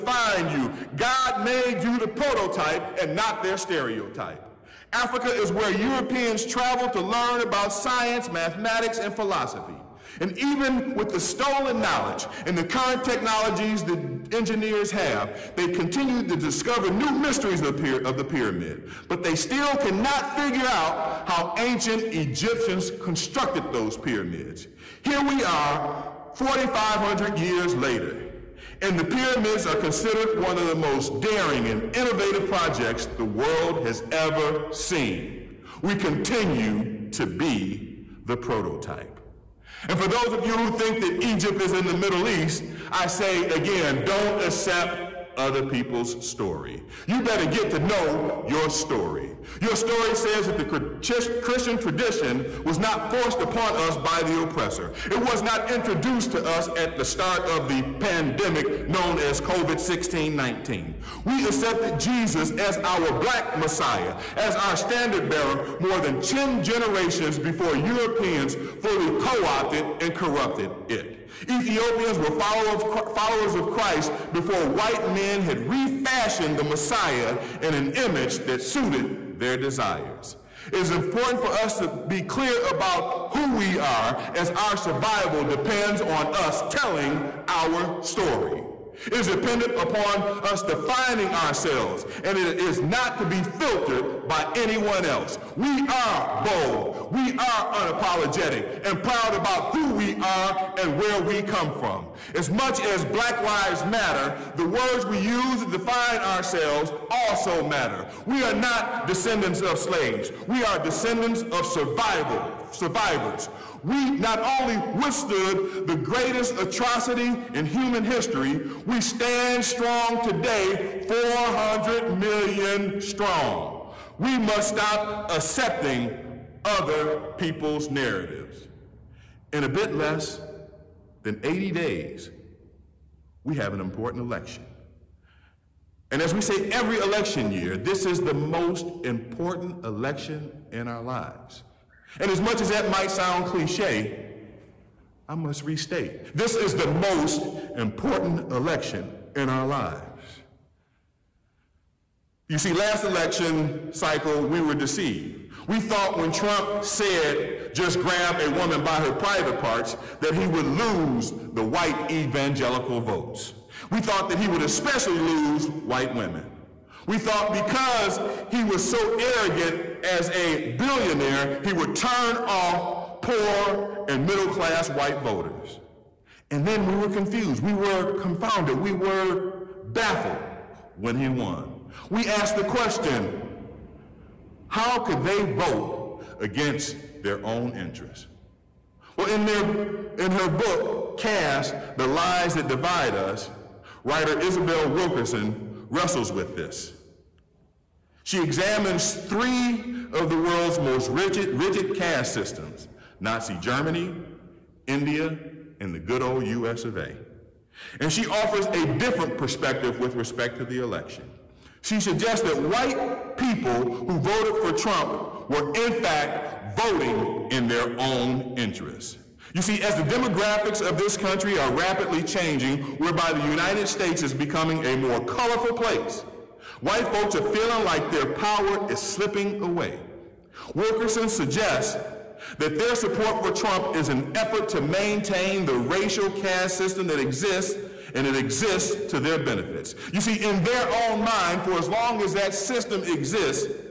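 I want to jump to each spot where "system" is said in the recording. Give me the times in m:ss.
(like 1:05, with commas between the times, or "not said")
3:22, 3:56, 4:02.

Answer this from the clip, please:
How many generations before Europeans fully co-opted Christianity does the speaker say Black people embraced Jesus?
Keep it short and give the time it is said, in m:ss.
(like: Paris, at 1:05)
10, at 1:06.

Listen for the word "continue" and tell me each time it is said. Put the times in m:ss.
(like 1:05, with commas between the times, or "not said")
0:15, 0:35.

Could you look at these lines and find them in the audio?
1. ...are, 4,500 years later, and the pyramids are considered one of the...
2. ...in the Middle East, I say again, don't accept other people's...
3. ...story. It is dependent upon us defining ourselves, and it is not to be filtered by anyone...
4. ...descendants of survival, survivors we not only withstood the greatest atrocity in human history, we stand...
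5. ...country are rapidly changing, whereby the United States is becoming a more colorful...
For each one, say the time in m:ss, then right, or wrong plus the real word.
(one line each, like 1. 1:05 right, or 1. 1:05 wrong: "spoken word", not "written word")
1. 0:25 right
2. 0:41 right
3. 1:28 right
4. 1:50 right
5. 3:41 right.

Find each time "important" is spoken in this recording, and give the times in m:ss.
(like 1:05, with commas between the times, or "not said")
1:20, 2:13, 2:19, 2:27.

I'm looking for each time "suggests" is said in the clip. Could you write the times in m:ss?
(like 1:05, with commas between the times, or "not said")
3:31, 3:51.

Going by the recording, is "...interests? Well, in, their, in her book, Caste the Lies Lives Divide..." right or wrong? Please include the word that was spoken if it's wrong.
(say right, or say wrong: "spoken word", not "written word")
wrong: "That", not "Lives".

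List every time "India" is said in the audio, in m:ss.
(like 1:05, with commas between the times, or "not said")
3:24.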